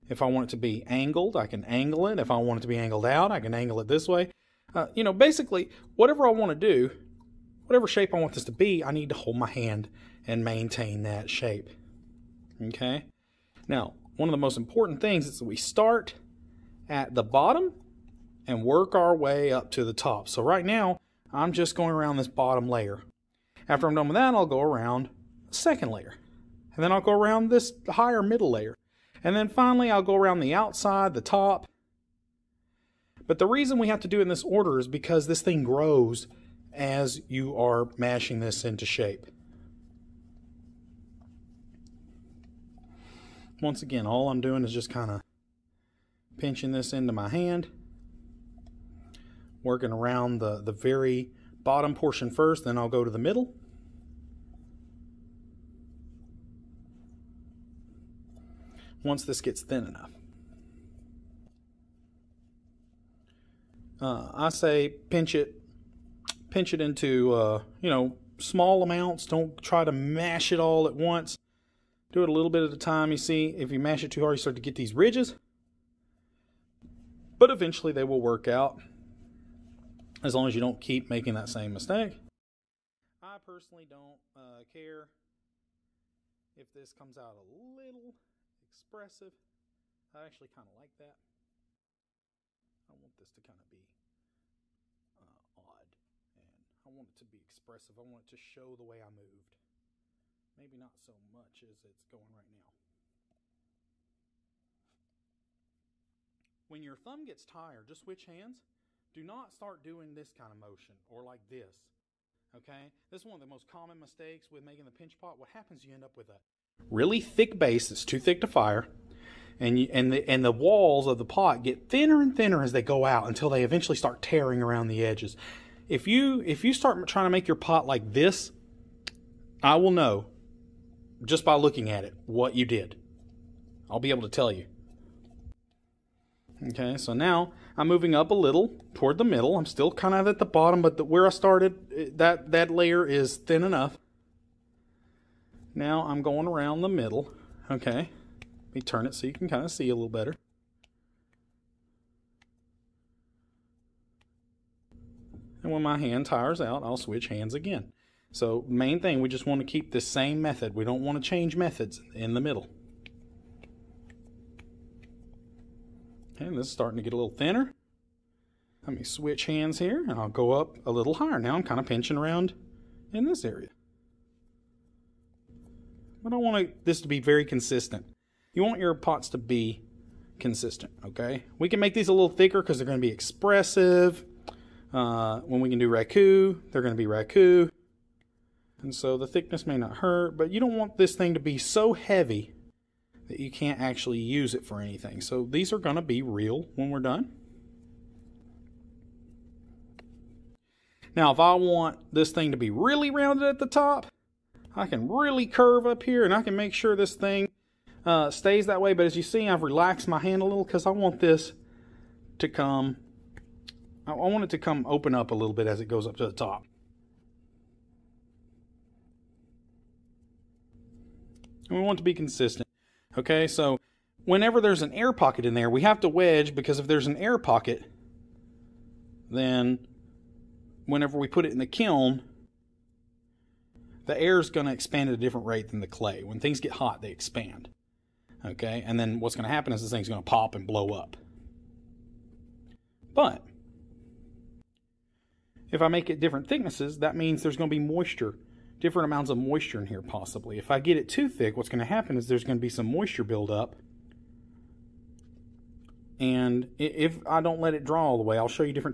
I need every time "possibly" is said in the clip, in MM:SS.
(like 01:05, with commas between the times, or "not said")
04:10.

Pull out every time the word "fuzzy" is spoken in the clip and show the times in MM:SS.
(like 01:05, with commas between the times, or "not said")
not said.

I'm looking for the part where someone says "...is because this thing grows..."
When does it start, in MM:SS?
00:34.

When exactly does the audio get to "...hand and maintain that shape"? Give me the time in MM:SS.
00:09.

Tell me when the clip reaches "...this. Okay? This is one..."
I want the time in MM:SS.
01:51.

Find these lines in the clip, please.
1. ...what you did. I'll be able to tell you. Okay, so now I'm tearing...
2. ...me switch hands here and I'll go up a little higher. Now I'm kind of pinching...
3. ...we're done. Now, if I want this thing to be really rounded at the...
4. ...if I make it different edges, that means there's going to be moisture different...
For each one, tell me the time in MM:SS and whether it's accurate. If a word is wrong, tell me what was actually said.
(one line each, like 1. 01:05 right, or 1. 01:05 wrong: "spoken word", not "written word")
1. 02:12 wrong: "moving", not "tearing"
2. 02:48 right
3. 03:16 right
4. 04:05 wrong: "thicknesses", not "edges".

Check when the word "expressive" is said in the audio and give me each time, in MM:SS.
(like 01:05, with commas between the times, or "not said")
01:28, 01:37, 03:03.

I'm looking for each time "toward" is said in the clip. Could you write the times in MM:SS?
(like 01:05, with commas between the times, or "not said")
02:18.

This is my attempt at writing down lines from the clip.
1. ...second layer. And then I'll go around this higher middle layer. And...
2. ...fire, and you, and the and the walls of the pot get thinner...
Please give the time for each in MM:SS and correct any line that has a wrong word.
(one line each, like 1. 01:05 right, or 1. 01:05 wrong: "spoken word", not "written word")
1. 00:25 right
2. 01:58 right.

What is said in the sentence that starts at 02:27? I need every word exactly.
Okay, let me turn it so you can kind of see a little better.